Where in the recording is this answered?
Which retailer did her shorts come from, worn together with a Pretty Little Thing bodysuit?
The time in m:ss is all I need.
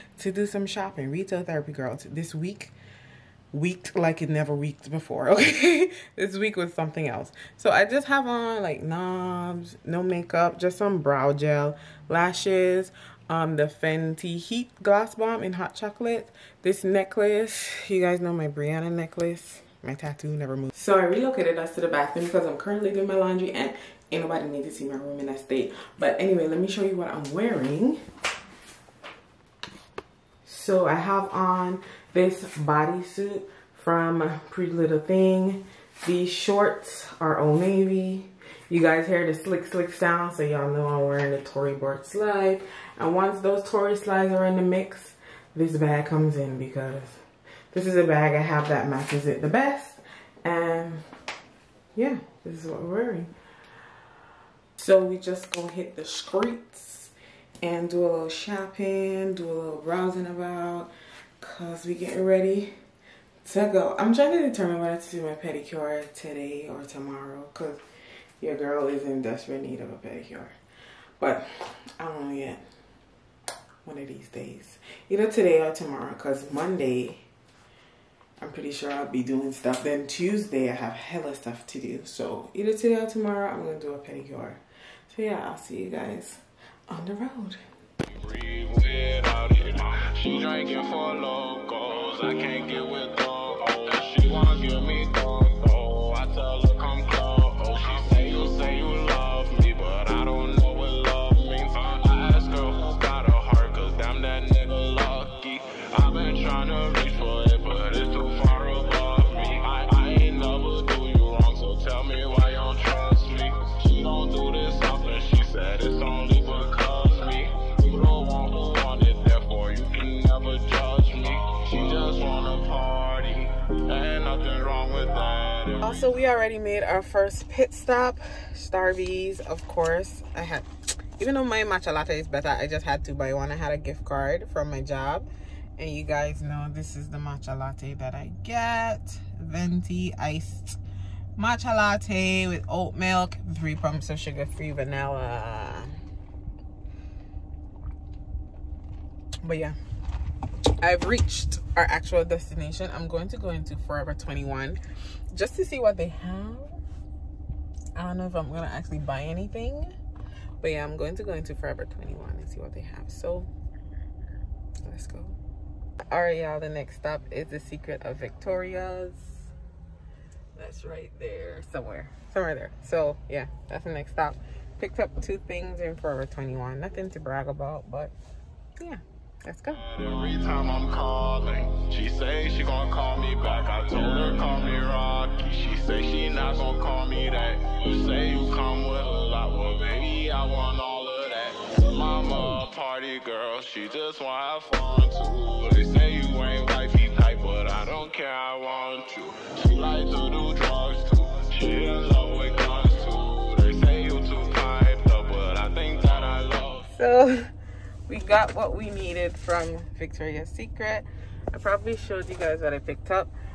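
0:37.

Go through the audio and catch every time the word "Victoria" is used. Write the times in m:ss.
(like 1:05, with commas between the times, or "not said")
2:48, 3:29.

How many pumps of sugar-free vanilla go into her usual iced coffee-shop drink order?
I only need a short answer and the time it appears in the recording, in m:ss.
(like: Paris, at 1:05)
3, at 2:23.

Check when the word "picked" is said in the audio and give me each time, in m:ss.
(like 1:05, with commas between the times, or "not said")
2:54, 3:32.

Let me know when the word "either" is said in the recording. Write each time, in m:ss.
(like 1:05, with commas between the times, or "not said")
1:15, 1:22.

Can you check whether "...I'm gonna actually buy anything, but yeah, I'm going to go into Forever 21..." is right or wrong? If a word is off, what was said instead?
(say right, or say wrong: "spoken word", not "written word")
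right.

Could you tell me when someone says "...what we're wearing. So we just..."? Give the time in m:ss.
0:52.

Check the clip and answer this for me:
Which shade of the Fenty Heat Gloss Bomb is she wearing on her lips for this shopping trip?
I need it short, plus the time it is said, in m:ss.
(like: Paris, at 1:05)
Hot Chocolate, at 0:15.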